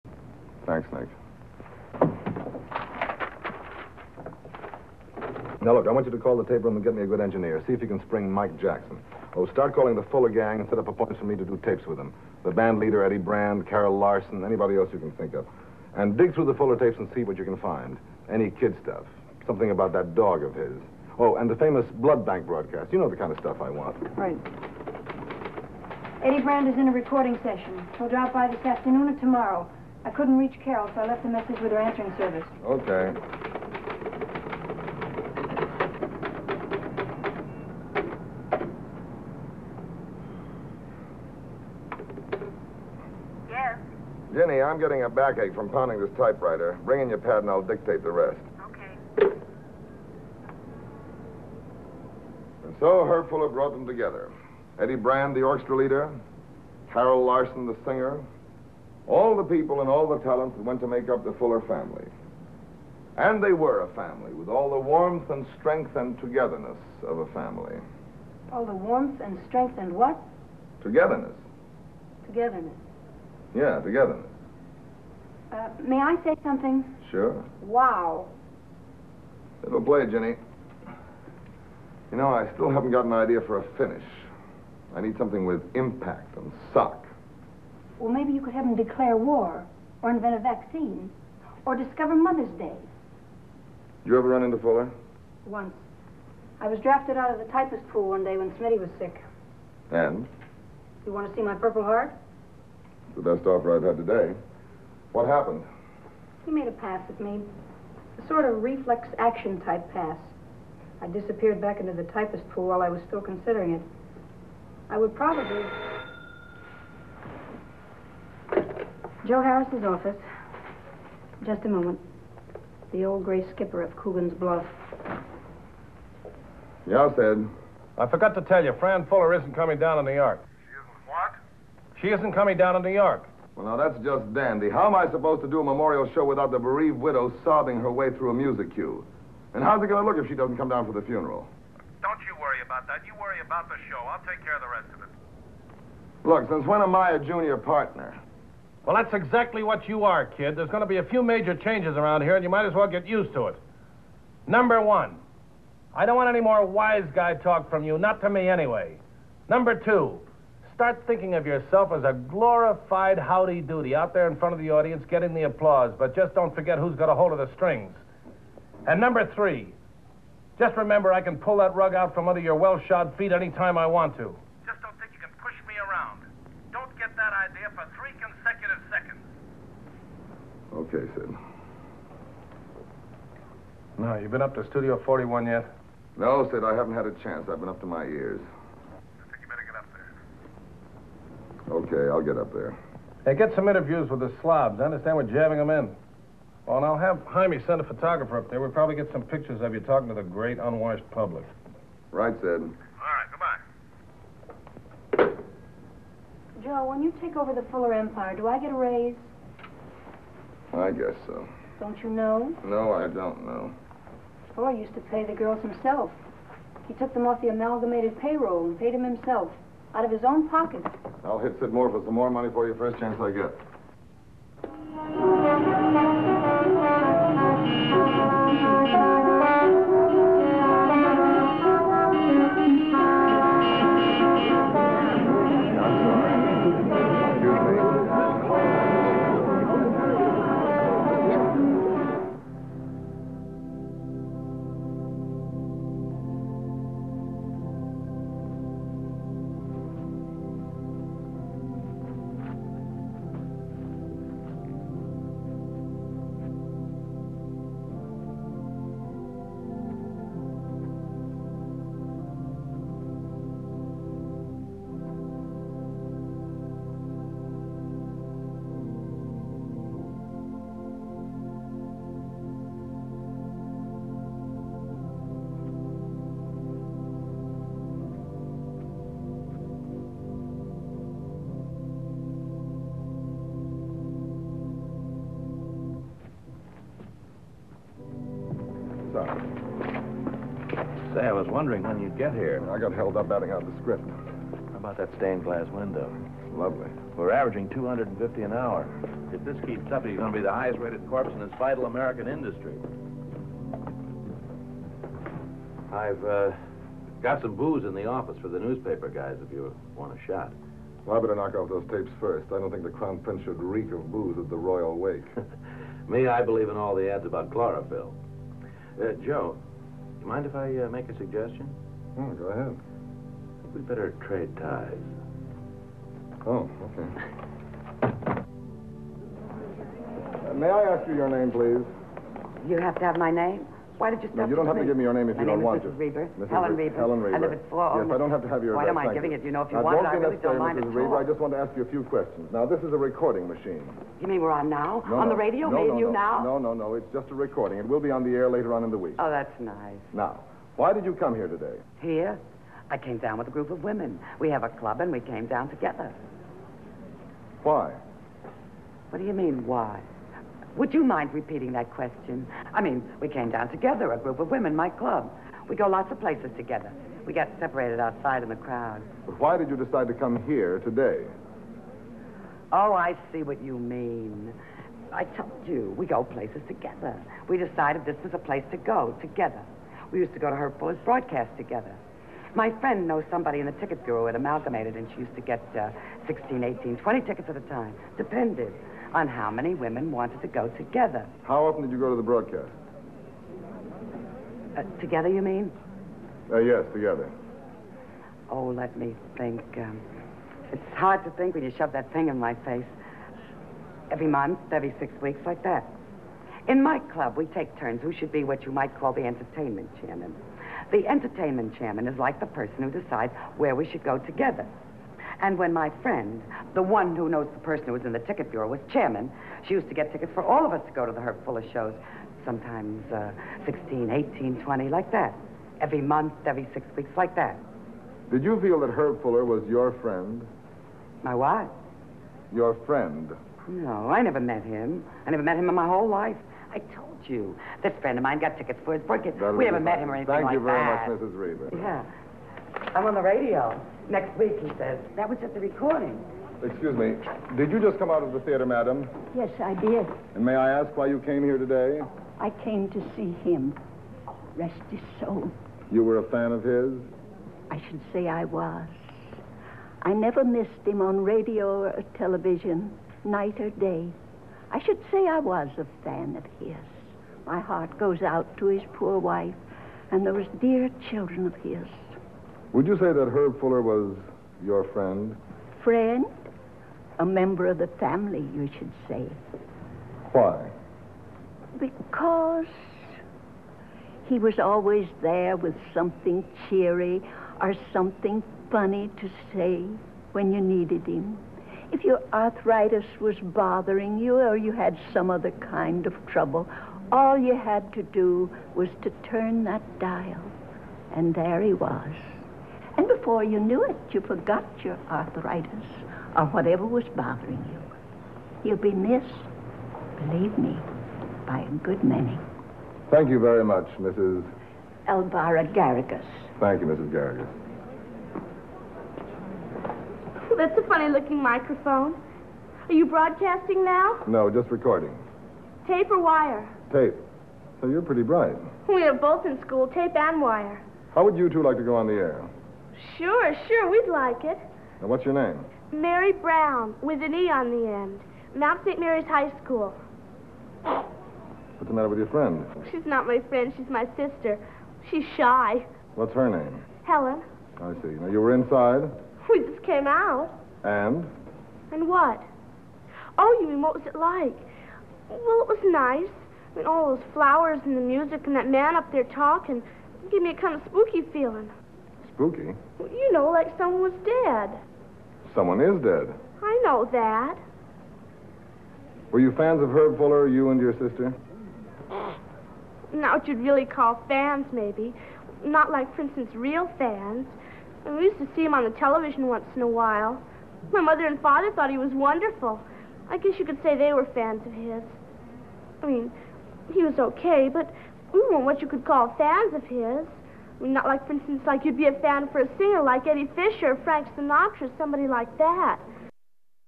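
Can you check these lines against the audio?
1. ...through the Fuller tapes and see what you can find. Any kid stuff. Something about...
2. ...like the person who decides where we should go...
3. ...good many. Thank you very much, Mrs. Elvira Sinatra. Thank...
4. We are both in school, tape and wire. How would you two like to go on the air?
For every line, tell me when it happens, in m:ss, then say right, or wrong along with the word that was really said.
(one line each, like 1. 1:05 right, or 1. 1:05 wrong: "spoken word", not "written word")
1. 0:16 right
2. 6:52 right
3. 8:31 wrong: "Garrigus", not "Sinatra"
4. 8:48 right.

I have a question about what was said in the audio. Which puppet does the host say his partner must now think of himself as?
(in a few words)
Howdy Doody.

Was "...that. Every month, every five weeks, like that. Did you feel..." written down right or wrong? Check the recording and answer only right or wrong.
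wrong.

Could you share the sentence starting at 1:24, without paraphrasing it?
I need something with impact and suck.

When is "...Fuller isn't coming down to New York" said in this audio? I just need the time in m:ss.
2:09.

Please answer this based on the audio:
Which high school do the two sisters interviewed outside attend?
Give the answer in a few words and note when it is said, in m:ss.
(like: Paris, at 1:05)
Mount St. Mary's High School, at 8:58.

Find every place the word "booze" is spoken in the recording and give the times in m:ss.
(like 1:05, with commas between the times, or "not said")
5:07, 5:14.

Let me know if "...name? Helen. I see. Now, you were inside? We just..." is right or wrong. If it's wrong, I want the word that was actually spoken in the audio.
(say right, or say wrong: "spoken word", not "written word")
right.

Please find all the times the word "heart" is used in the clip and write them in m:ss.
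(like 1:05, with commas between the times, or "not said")
1:41, 7:47.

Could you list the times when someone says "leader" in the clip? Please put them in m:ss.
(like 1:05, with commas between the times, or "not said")
0:12, 0:55.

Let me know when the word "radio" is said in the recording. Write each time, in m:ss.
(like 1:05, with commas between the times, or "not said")
5:45, 7:23, 7:41.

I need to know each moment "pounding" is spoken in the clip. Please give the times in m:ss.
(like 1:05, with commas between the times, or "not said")
0:45.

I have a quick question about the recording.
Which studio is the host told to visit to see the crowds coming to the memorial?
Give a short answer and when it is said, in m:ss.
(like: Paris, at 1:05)
Studio 41, at 3:04.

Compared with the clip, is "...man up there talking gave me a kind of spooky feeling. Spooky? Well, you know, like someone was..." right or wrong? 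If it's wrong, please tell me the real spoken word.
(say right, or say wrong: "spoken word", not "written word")
right.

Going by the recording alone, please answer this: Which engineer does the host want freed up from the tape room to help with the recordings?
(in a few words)
Mike Jackson.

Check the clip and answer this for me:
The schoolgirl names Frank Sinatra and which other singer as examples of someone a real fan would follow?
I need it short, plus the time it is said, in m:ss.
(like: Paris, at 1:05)
Eddie Fisher, at 9:53.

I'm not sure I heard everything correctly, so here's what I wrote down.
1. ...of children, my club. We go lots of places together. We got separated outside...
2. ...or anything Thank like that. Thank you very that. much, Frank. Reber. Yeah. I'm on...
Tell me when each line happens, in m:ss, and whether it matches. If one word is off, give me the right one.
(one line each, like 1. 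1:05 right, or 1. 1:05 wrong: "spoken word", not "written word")
1. 6:04 wrong: "women", not "children"
2. 7:20 wrong: "Mrs", not "Frank".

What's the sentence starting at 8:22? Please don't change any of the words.
And before you knew it, you forgot your arthritis or whatever was bothering you.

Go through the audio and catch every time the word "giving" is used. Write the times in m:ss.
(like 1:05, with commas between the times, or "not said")
5:39.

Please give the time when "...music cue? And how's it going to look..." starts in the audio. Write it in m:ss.
2:18.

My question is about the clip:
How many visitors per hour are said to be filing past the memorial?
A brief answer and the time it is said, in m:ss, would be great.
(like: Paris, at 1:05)
250, at 4:57.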